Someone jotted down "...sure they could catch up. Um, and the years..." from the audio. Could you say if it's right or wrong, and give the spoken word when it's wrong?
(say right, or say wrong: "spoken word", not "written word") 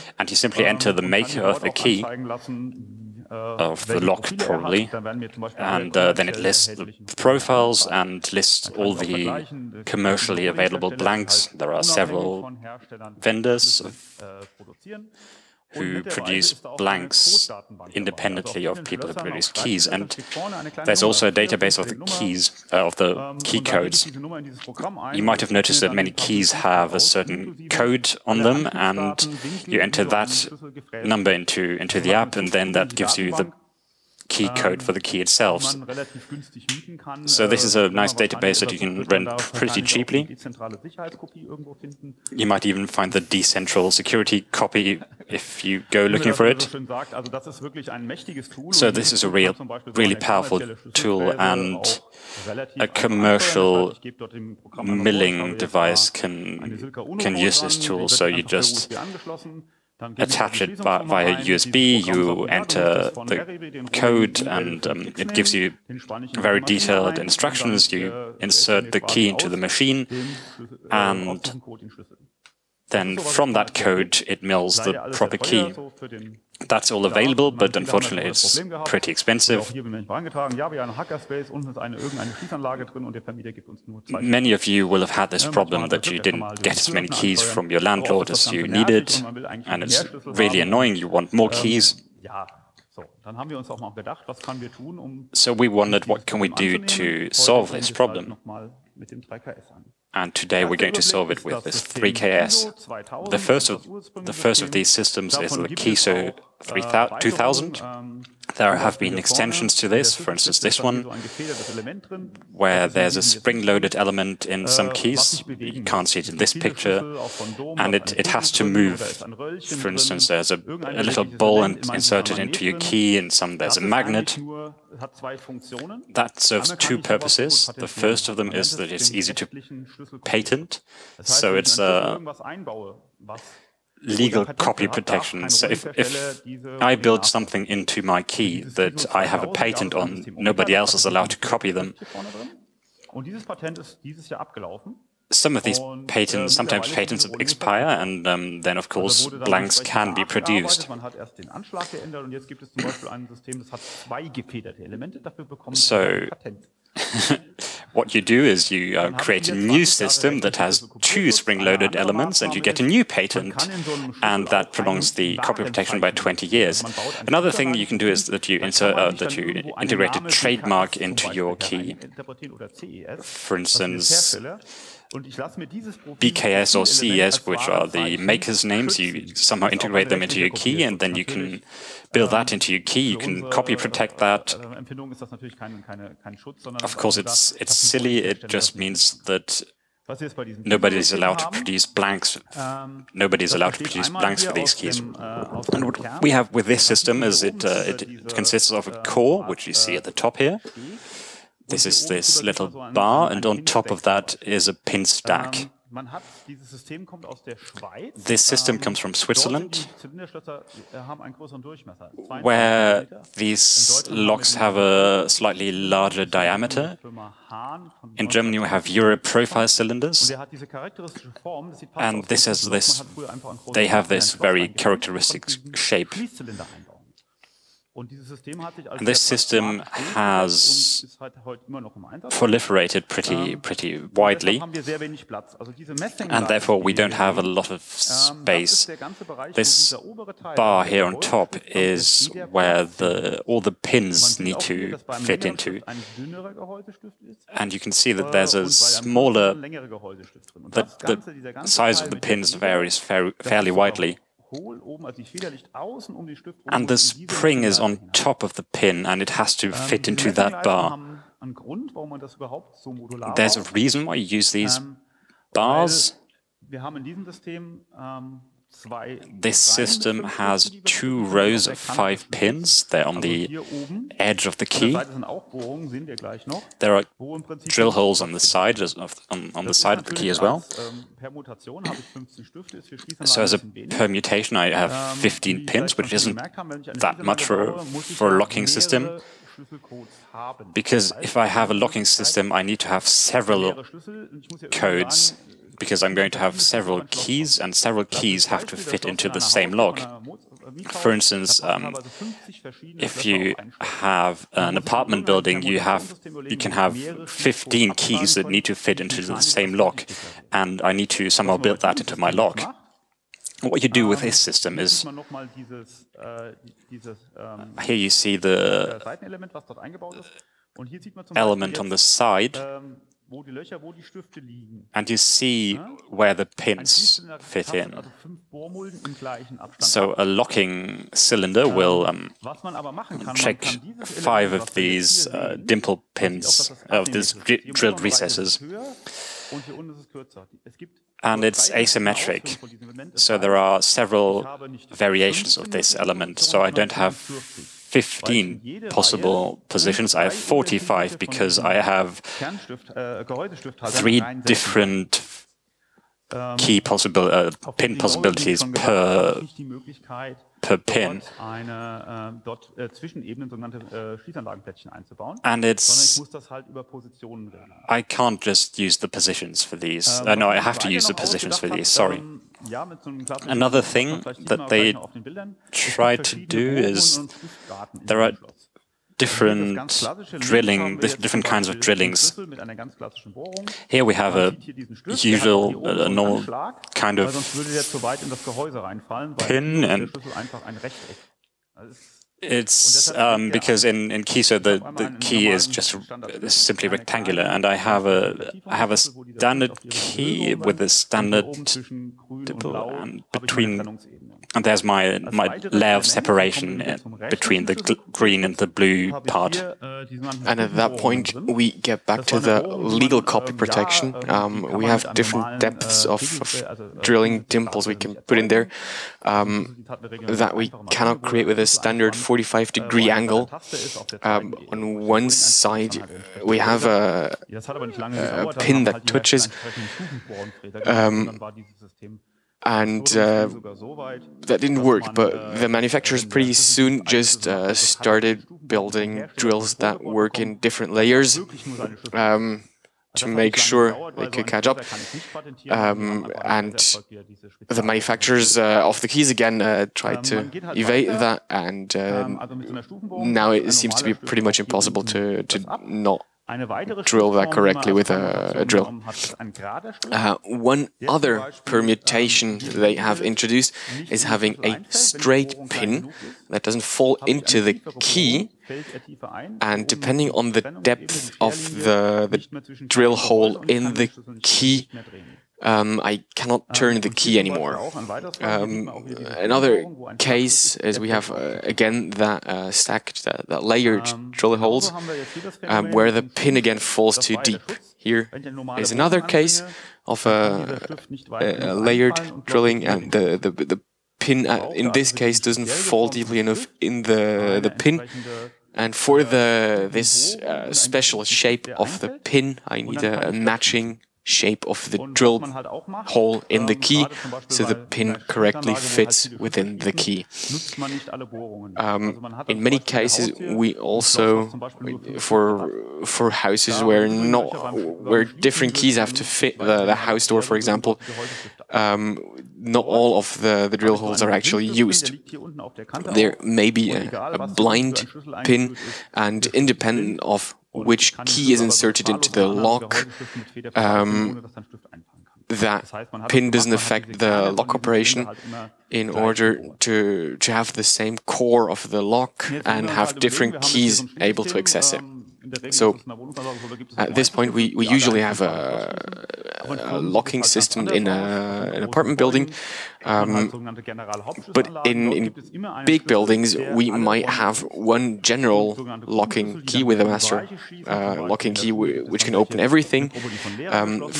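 wrong: "manufacturers", not "years".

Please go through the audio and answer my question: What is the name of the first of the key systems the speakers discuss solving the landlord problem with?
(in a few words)
KESO 3000.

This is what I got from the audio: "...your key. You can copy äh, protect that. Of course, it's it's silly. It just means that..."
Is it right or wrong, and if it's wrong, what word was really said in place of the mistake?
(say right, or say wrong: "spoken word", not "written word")
right.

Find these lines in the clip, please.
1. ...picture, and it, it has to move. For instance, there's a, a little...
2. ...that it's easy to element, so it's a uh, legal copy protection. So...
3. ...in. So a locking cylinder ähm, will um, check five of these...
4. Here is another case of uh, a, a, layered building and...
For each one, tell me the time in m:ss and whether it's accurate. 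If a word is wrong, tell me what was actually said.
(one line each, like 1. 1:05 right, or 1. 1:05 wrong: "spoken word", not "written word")
1. 1:56 right
2. 2:08 wrong: "patent", not "element"
3. 5:27 right
4. 8:07 wrong: "drilling", not "building".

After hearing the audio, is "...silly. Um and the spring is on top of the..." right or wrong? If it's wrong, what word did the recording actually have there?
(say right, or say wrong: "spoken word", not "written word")
wrong: "widely", not "silly".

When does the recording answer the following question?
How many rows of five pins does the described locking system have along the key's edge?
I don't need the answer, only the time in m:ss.
4:30.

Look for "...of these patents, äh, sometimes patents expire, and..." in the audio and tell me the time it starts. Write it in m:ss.
2:25.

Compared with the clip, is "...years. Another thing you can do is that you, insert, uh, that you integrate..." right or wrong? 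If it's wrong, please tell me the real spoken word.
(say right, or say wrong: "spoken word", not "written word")
right.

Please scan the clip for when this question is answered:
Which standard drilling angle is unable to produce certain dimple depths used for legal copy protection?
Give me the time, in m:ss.
7:02.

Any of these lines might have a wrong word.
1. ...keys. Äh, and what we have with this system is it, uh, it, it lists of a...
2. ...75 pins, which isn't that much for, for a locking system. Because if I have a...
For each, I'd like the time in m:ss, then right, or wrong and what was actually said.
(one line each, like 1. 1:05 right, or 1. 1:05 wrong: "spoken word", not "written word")
1. 3:14 wrong: "consists", not "lists"
2. 4:45 wrong: "15", not "75".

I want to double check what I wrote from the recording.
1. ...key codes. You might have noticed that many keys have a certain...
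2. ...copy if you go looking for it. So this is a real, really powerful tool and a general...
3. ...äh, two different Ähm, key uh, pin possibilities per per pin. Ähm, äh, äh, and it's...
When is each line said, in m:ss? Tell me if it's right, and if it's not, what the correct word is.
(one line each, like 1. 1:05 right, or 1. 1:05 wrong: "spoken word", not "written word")
1. 0:23 right
2. 0:44 wrong: "commercial", not "general"
3. 5:52 wrong: "three", not "two".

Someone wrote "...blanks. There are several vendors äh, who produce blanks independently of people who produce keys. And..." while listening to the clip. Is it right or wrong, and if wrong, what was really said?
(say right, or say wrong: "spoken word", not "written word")
right.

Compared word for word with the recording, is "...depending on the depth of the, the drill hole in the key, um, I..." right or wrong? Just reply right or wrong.
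right.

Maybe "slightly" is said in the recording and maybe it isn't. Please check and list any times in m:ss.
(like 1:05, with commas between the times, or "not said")
3:35.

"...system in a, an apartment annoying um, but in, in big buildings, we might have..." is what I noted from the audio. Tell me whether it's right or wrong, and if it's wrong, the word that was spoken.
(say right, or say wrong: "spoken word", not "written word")
wrong: "building", not "annoying".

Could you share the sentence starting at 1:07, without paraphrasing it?
You insert the key into the machine äh, and then from that code it mills the proper key.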